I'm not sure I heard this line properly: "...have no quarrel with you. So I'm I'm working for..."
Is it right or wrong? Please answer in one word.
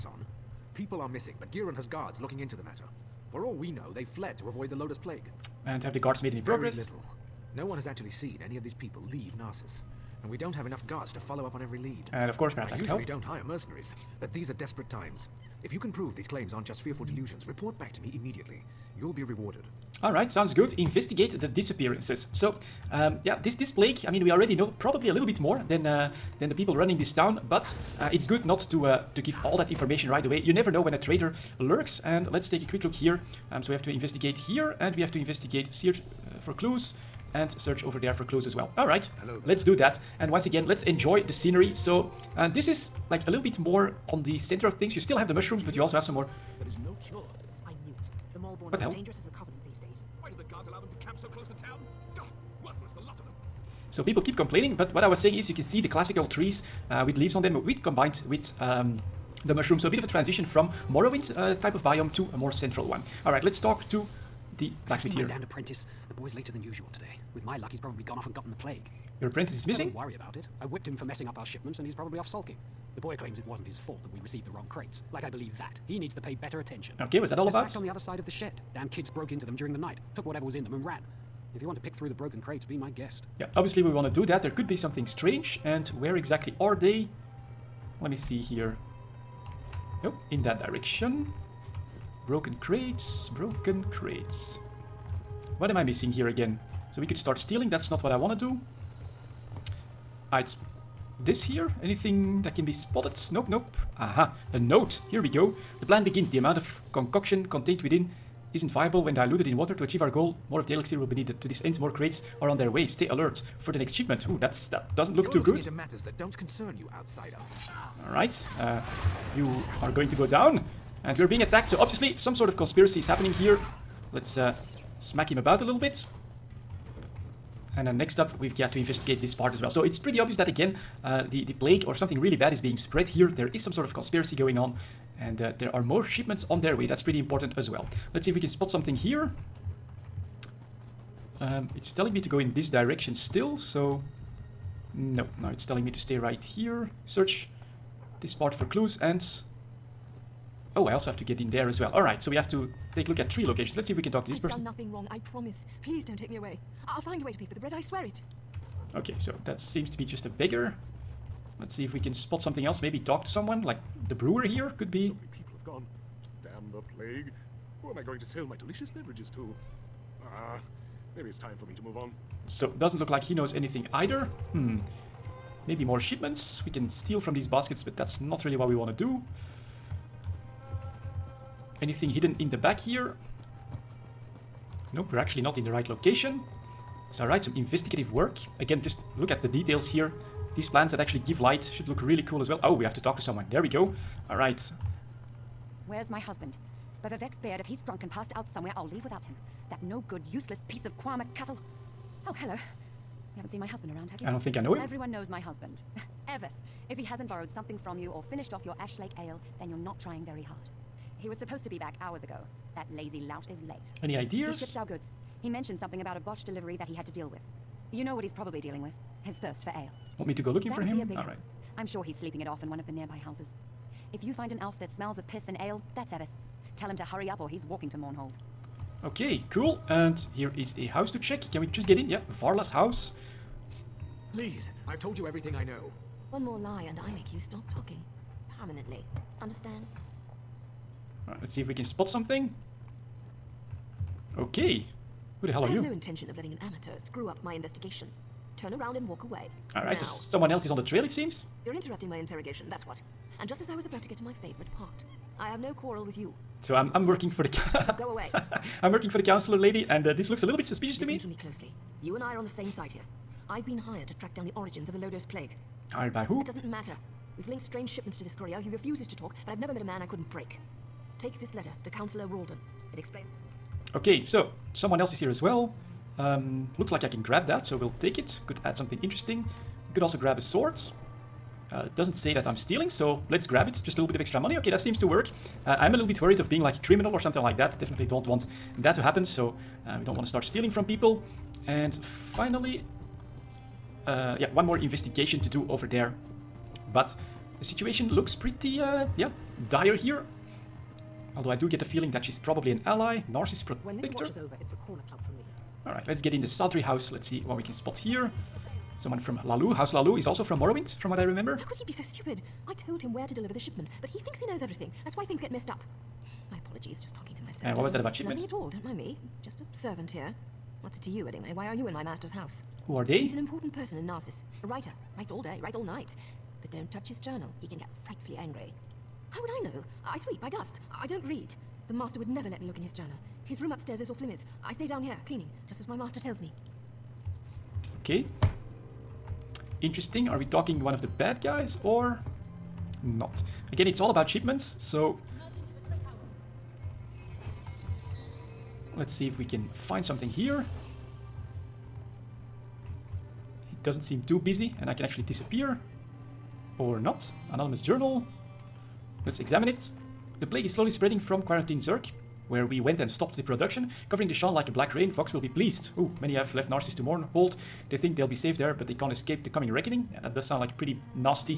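right.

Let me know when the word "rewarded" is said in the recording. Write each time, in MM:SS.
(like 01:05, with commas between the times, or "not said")
00:19.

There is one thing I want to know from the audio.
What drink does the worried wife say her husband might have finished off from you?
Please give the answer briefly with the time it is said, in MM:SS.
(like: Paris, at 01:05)
Ashlake Ale, at 03:28.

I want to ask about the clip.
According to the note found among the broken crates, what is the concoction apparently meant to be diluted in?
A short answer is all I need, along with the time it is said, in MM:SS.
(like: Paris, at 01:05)
Water, at 01:49.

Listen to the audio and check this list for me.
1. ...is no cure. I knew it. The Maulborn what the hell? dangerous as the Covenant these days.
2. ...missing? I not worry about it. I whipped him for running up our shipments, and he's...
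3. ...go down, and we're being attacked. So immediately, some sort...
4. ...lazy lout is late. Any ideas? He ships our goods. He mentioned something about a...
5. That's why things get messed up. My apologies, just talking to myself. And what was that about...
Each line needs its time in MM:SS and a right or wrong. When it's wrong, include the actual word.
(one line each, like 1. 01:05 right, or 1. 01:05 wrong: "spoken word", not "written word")
1. 00:46 right
2. 01:09 wrong: "messing", not "running"
3. 02:00 wrong: "obviously", not "immediately"
4. 03:32 right
5. 05:15 right.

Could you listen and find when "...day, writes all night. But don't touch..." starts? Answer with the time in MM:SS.
05:25.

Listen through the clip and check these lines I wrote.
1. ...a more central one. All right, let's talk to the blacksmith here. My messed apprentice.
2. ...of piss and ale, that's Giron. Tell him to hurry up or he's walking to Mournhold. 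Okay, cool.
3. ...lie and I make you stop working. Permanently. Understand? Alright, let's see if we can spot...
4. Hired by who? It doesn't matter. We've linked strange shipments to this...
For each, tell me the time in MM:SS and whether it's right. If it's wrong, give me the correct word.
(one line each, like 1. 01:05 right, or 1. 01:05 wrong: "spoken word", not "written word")
1. 01:02 wrong: "damned", not "messed"
2. 03:45 wrong: "Evis", not "Giron"
3. 03:56 wrong: "talking", not "working"
4. 04:25 right.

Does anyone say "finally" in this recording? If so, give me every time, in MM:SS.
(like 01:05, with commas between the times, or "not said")
04:52.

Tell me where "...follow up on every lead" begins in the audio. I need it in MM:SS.
00:11.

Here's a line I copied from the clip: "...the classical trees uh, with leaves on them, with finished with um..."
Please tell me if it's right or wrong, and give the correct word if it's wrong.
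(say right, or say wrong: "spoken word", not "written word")
wrong: "combined", not "finished".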